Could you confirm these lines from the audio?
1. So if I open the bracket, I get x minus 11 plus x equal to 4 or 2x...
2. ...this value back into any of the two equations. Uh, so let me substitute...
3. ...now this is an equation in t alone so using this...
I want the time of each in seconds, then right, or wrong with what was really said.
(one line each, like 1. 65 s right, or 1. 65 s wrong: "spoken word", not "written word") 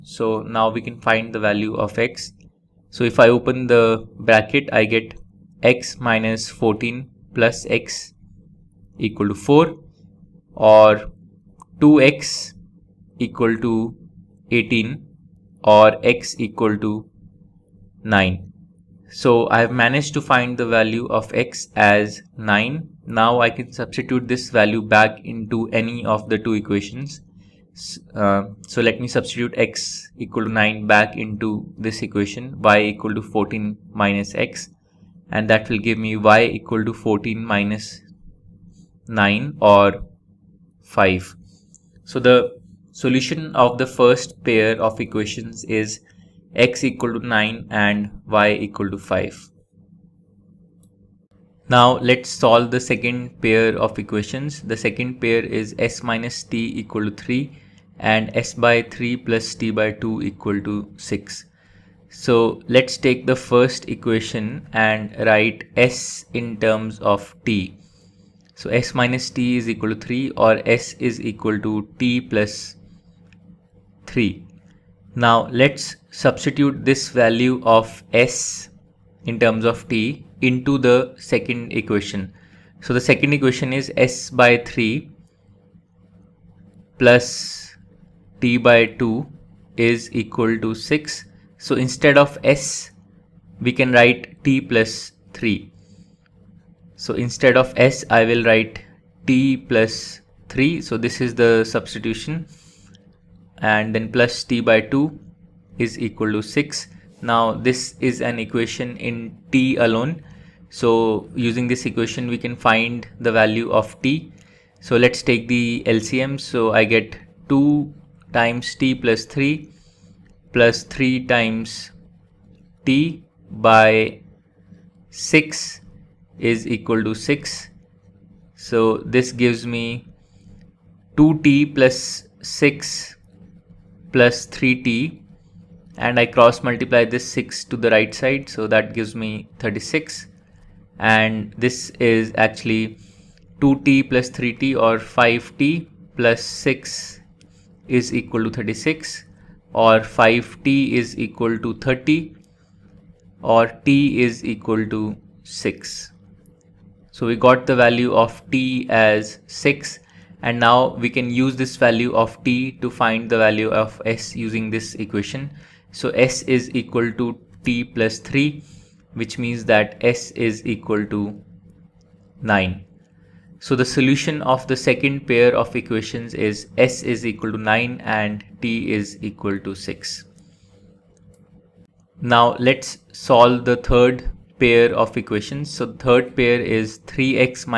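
1. 2 s wrong: "14", not "11"
2. 24 s right
3. 107 s right.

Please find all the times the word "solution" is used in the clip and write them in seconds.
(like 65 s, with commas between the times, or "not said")
42 s, 173 s.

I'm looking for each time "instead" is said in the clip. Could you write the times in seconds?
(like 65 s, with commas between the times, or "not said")
91 s, 97 s.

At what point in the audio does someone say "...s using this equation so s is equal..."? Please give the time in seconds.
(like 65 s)
164 s.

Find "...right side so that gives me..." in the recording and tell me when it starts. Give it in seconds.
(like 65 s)
137 s.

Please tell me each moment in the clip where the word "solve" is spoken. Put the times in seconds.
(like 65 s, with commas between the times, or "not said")
52 s, 183 s.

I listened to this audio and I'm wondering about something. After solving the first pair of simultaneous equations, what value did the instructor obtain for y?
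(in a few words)
5.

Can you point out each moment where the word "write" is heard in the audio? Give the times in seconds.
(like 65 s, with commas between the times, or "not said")
65 s, 93 s, 98 s.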